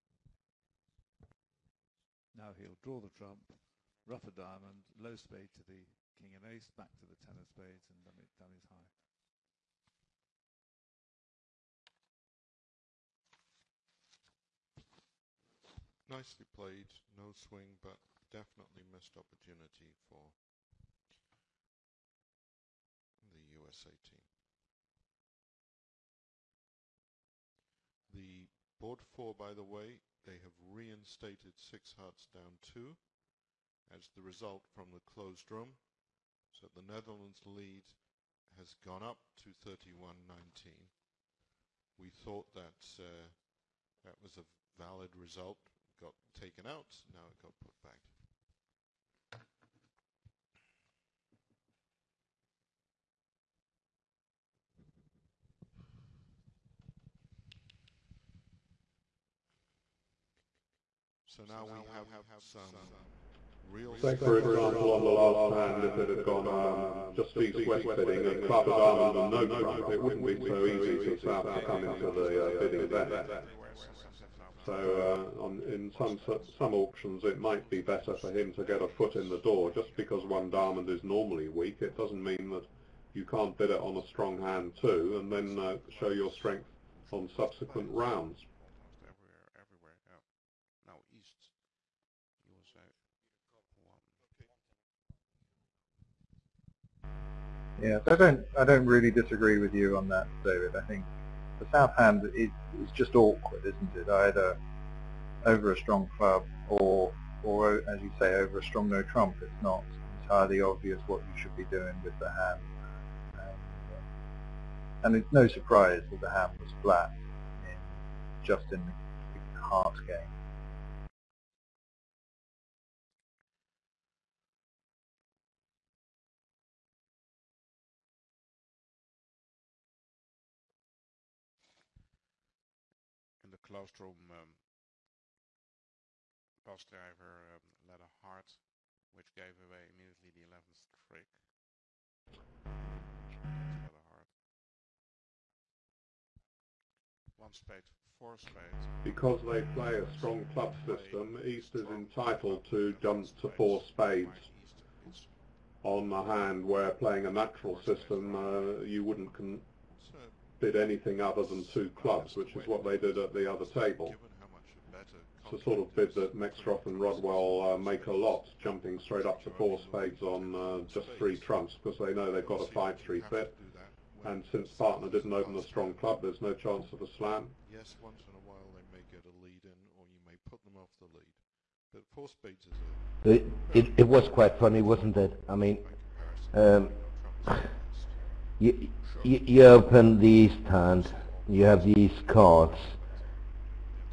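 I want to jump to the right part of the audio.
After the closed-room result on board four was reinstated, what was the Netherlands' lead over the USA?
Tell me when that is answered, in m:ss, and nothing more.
0:39.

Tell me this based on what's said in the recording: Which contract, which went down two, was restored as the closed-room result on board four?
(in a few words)
Six hearts.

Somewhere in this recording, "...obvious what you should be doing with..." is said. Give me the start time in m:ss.
1:50.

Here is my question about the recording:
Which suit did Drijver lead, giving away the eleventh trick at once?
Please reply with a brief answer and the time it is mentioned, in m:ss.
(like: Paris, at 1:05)
A heart, at 2:17.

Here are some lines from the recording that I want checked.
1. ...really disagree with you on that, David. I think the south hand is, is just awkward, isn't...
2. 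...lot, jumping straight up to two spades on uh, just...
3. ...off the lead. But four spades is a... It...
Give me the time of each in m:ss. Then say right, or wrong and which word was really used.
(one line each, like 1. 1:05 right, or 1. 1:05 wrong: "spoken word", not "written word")
1. 1:38 right
2. 2:48 wrong: "four", not "two"
3. 3:00 right.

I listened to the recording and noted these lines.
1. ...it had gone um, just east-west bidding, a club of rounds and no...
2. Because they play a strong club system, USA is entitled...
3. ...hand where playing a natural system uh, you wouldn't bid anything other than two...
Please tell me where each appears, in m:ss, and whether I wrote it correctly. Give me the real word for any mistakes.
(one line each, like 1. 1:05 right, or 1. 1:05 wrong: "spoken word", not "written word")
1. 1:05 wrong: "diamonds", not "rounds"
2. 2:29 wrong: "East", not "USA"
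3. 2:36 right.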